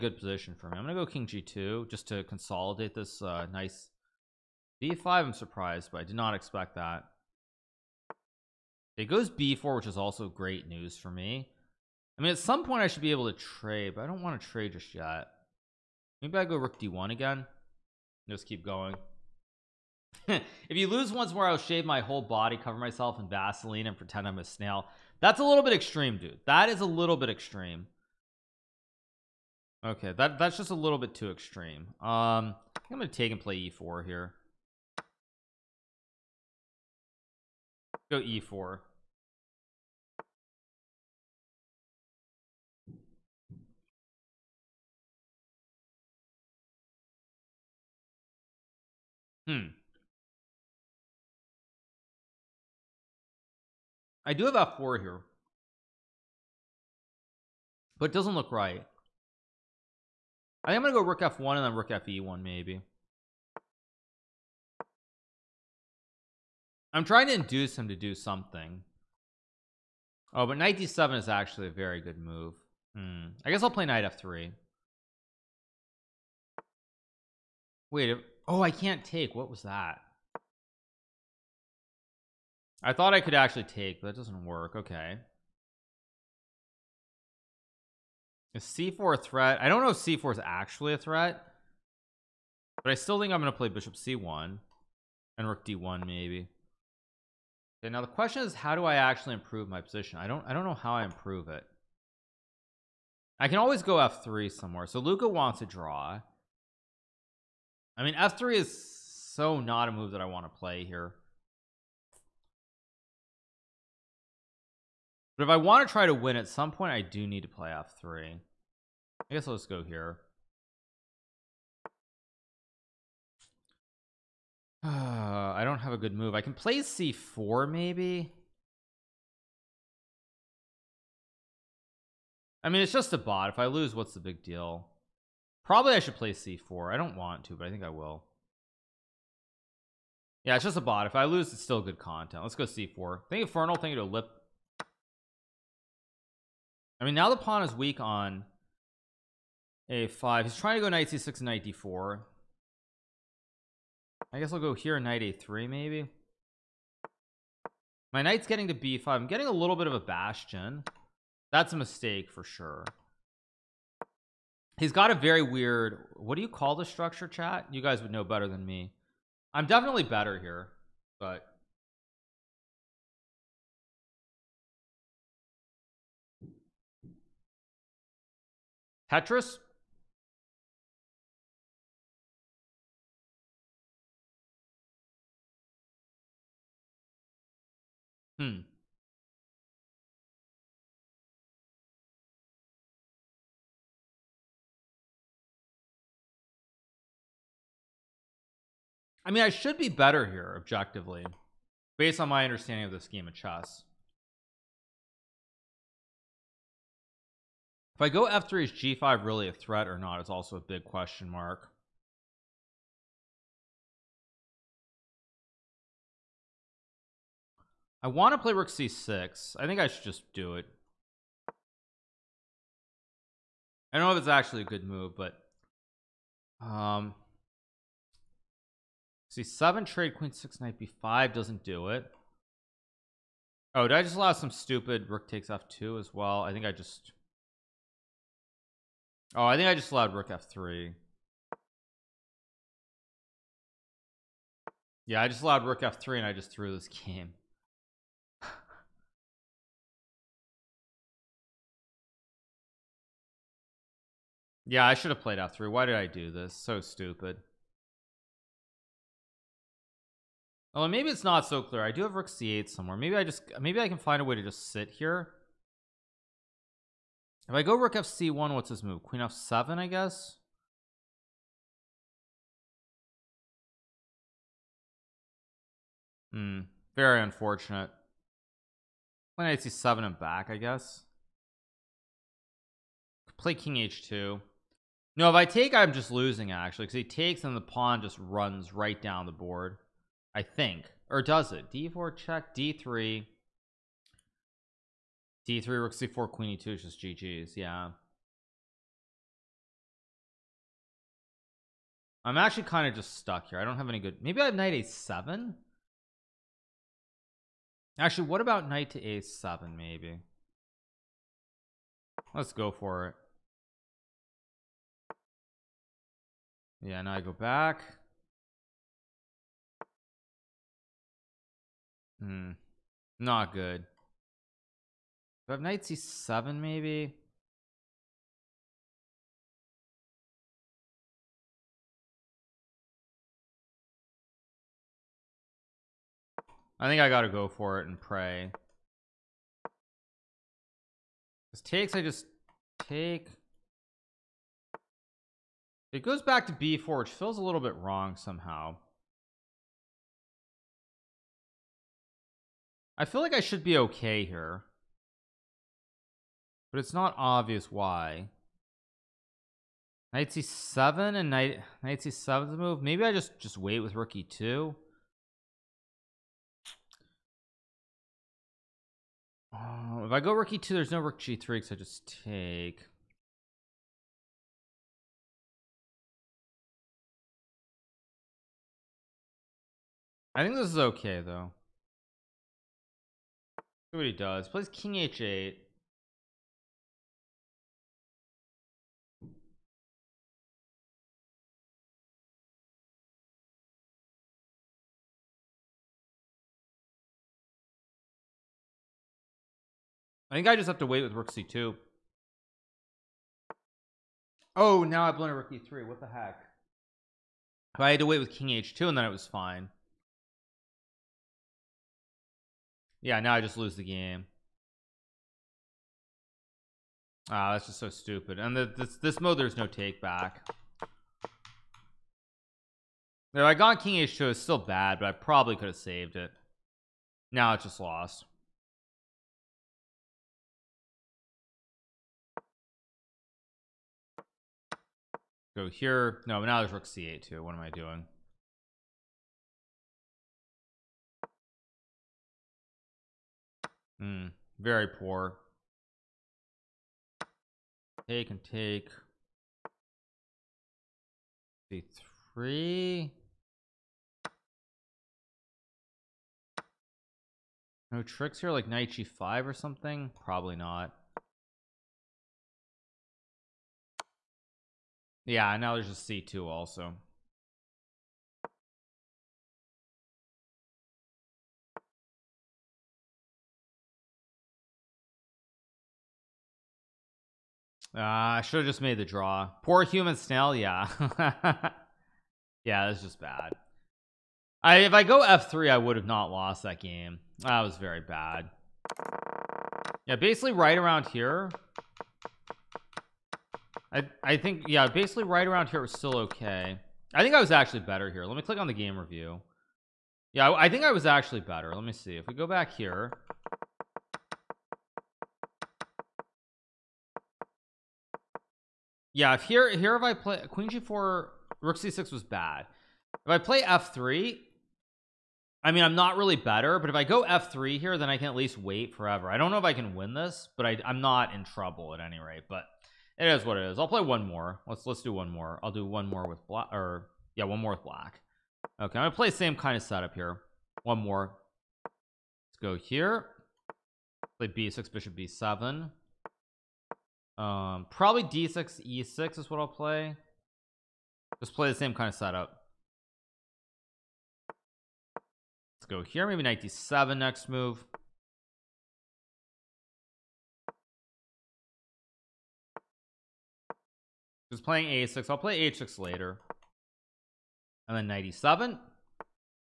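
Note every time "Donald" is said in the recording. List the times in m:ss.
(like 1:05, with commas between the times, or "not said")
not said.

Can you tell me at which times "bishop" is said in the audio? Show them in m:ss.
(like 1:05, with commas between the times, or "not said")
1:33, 8:54.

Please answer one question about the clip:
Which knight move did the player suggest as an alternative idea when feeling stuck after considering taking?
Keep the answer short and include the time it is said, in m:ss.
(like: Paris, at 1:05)
knight A7, at 5:04.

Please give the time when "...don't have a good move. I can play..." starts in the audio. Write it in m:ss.
2:05.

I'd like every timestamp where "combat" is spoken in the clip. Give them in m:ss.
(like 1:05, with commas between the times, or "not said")
not said.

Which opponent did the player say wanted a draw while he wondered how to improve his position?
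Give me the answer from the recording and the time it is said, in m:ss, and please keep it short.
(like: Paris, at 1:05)
Luka, at 1:45.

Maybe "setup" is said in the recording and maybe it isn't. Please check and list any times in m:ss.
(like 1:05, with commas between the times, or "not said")
8:49, 9:02.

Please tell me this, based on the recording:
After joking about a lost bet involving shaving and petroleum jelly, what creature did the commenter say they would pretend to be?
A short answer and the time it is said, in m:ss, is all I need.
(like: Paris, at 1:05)
a snail, at 0:24.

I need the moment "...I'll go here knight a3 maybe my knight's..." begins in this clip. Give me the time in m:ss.
2:34.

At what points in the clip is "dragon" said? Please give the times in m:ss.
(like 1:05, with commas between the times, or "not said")
not said.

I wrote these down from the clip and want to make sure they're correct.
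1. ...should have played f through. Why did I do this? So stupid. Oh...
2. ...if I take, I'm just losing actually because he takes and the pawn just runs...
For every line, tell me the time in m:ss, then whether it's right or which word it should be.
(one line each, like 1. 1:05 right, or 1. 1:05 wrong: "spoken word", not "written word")
1. 4:14 right
2. 4:45 right.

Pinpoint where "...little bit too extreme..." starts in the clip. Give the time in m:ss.
0:30.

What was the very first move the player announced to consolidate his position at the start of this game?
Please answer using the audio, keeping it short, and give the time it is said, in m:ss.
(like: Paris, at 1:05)
King g2, at 0:01.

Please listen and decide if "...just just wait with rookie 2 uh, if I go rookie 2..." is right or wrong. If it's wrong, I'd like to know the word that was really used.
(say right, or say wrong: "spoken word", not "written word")
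right.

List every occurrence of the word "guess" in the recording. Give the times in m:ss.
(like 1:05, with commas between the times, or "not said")
1:13, 1:59, 2:34, 4:29, 4:40.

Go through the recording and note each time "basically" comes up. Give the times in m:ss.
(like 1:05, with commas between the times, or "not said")
8:10, 8:14.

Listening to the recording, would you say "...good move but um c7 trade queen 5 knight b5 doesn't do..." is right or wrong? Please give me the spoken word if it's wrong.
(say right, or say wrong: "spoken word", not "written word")
wrong: "6", not "5".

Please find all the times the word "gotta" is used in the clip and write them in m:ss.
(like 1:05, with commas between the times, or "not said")
5:37.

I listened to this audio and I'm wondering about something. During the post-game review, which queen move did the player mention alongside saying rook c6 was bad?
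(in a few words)
Queen g4.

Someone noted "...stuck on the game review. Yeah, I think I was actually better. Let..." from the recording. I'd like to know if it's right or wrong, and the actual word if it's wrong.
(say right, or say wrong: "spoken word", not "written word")
wrong: "click", not "stuck".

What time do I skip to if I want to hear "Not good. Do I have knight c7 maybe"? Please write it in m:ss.
5:23.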